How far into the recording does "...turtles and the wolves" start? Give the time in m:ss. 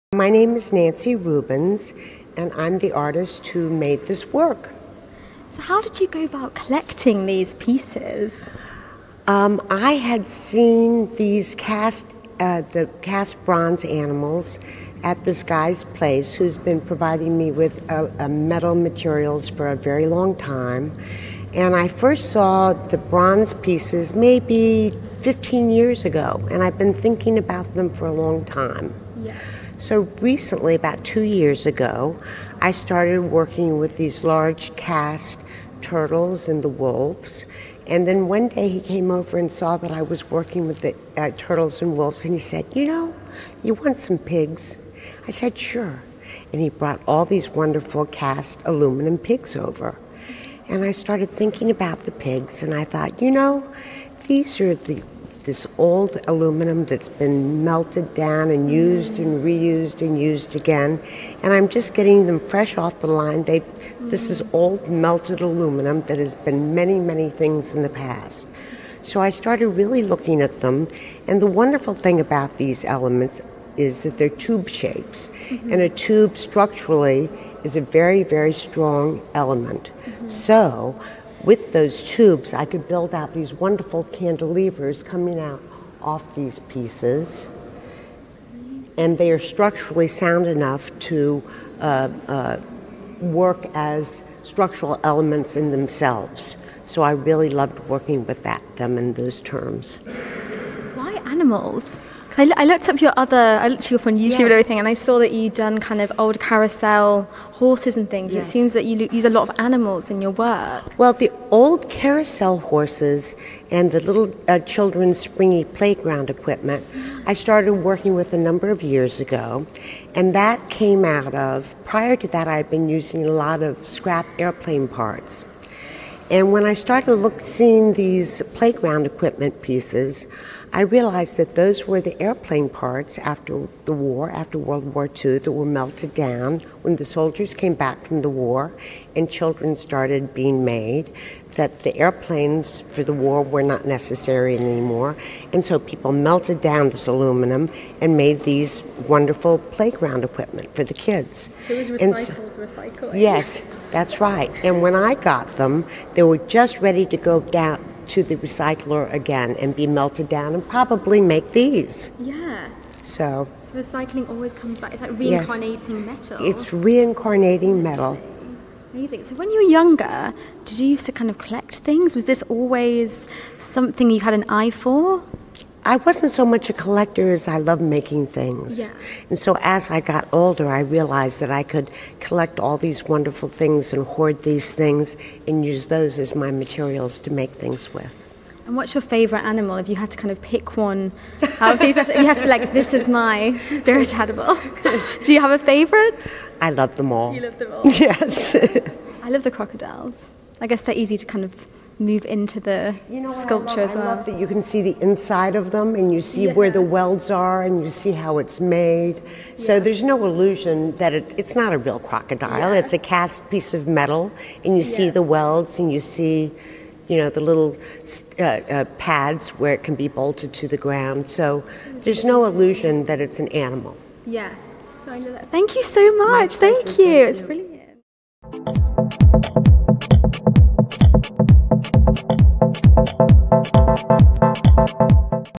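0:35.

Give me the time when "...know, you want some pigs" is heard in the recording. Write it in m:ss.
0:42.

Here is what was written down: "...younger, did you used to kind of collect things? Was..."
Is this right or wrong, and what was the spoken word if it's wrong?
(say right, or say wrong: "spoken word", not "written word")
right.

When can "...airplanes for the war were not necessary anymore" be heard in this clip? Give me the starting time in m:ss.
2:21.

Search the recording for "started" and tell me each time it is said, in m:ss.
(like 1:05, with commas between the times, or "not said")
0:32, 0:50, 1:09, 1:57, 2:06, 2:19.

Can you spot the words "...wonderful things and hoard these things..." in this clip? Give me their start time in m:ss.
3:03.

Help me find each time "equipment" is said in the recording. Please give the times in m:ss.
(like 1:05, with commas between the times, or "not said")
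1:56, 2:09, 2:30.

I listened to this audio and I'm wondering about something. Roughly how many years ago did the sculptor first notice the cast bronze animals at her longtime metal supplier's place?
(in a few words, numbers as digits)
15 years.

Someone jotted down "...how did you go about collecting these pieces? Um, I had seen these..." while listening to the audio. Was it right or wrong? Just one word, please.
right.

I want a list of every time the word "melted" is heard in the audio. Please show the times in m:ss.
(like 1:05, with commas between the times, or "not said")
0:57, 1:04, 2:15, 2:26, 2:39.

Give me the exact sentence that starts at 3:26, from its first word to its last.
where the welds are and you see how it's made.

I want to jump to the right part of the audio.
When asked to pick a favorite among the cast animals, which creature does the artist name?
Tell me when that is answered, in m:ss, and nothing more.
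3:19.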